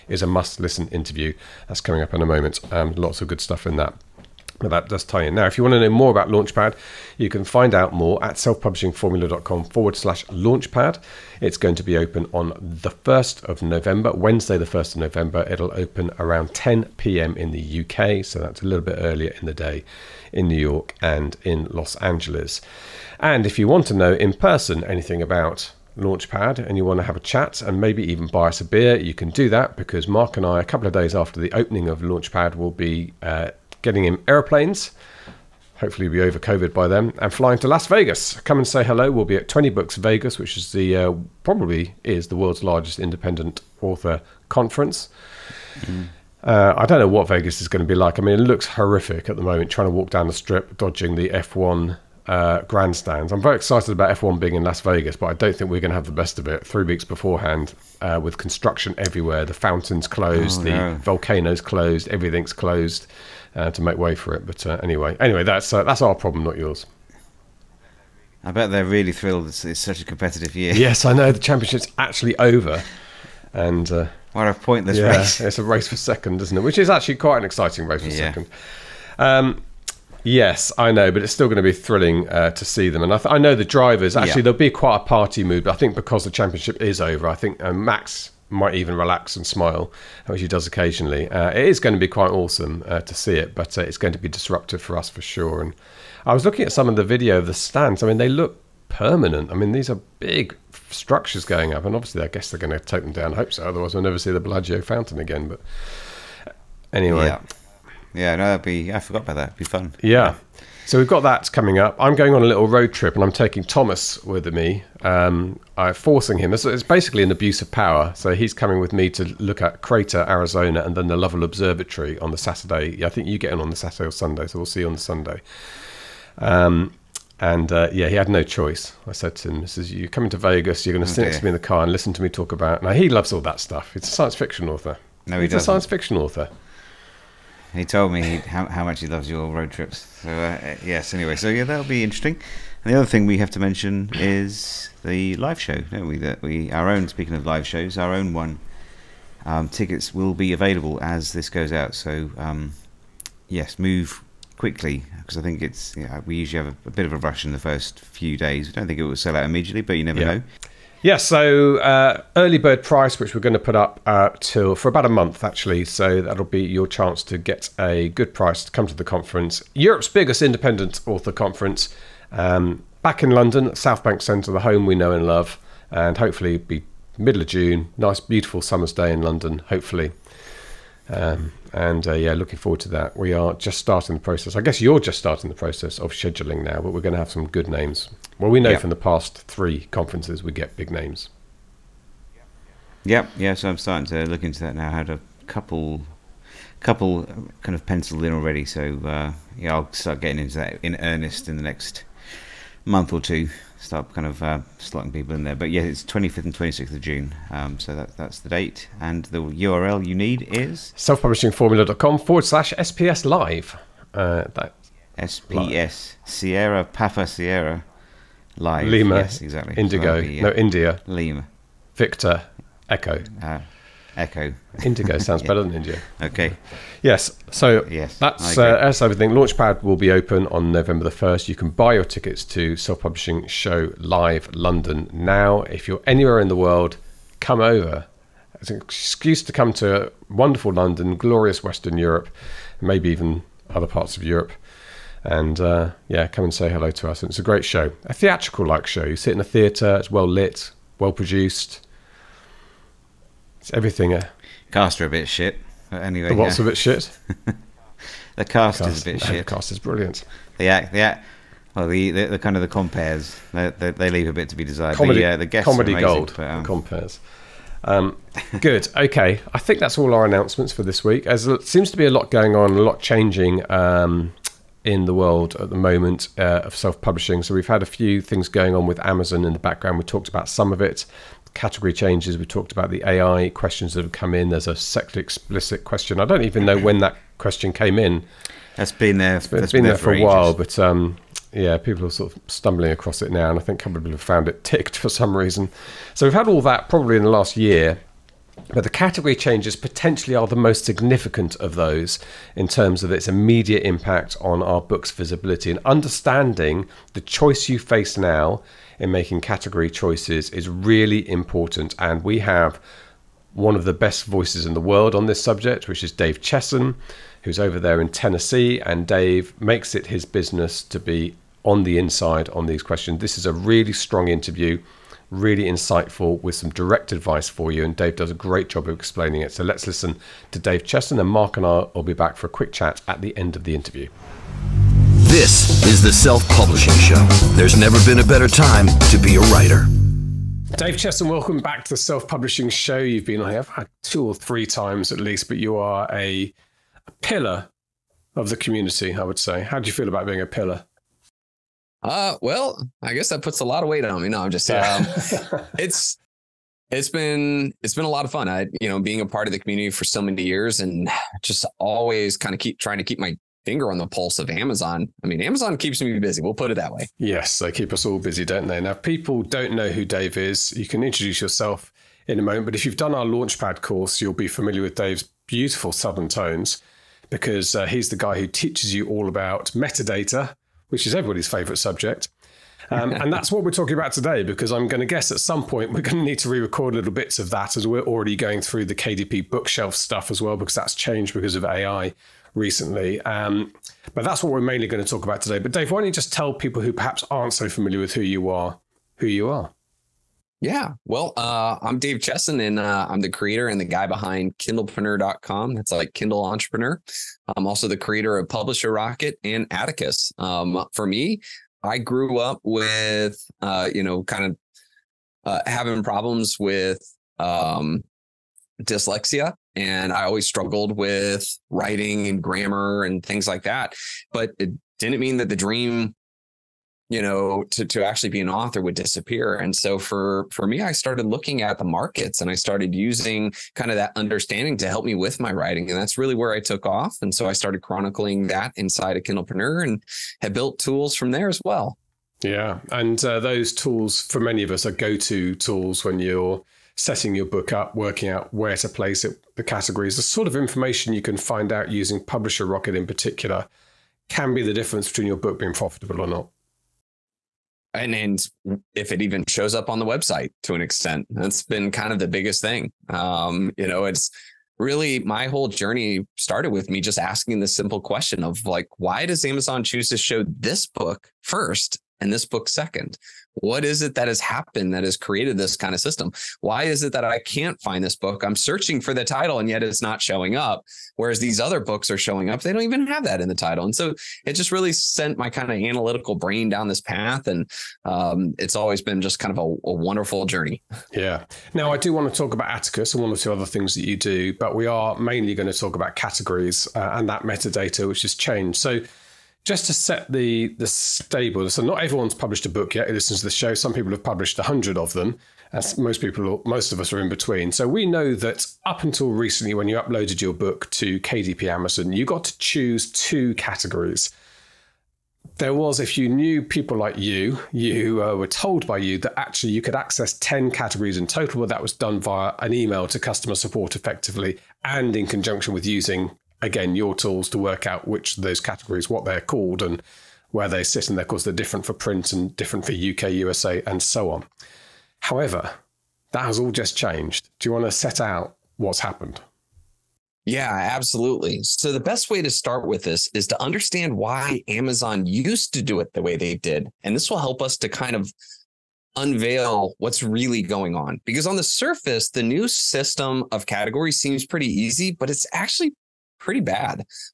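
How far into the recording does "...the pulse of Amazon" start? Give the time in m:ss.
6:03.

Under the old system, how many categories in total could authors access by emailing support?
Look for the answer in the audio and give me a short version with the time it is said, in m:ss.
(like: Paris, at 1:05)
10, at 8:40.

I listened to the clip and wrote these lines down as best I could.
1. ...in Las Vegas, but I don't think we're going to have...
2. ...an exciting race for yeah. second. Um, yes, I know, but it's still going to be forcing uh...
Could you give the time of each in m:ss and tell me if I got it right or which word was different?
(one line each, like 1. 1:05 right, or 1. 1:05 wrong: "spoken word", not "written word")
1. 0:54 right
2. 1:17 wrong: "thrilling", not "forcing".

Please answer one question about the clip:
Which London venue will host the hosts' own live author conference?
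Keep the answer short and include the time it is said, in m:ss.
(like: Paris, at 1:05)
South Bank Centre, at 2:53.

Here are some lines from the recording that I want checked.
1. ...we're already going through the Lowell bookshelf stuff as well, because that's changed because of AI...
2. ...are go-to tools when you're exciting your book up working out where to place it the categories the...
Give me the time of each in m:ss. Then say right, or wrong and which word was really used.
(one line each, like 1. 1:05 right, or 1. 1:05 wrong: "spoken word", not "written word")
1. 6:27 wrong: "KDP", not "Lowell"
2. 7:24 wrong: "setting", not "exciting".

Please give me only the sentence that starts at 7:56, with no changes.
Why is it that I can't find this book?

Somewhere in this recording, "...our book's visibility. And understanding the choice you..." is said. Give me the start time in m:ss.
5:04.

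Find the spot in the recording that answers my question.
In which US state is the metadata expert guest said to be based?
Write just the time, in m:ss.
5:18.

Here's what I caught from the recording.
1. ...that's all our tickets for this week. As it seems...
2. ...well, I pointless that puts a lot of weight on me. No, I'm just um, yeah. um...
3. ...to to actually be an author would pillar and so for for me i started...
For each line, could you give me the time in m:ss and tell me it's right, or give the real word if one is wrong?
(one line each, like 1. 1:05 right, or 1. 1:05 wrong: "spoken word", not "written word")
1. 4:29 wrong: "announcements", not "tickets"
2. 5:52 wrong: "guess", not "pointless"
3. 7:07 wrong: "disappear", not "pillar".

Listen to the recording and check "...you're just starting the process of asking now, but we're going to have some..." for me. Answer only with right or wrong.
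wrong.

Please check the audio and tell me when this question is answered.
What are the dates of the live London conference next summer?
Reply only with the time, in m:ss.
3:26.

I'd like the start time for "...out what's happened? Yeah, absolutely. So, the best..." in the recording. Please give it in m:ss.
8:58.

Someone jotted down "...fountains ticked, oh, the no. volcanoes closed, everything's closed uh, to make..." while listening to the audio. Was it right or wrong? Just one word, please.
wrong.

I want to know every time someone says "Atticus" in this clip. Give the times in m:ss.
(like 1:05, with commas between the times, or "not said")
6:49, 8:12.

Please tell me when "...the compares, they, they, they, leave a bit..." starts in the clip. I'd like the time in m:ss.
4:22.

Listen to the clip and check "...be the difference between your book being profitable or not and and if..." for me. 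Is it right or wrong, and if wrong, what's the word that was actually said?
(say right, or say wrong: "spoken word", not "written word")
right.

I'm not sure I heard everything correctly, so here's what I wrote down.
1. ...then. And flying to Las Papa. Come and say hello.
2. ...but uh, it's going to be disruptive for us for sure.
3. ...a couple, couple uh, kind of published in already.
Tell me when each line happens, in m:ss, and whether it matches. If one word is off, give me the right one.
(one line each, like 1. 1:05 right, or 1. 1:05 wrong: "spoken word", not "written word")
1. 0:36 wrong: "Vegas", not "Papa"
2. 1:33 right
3. 3:15 wrong: "penciled", not "published".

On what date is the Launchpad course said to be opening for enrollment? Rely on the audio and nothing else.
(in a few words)
1st of November.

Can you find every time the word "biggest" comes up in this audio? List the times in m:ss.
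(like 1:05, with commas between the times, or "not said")
2:50, 7:42.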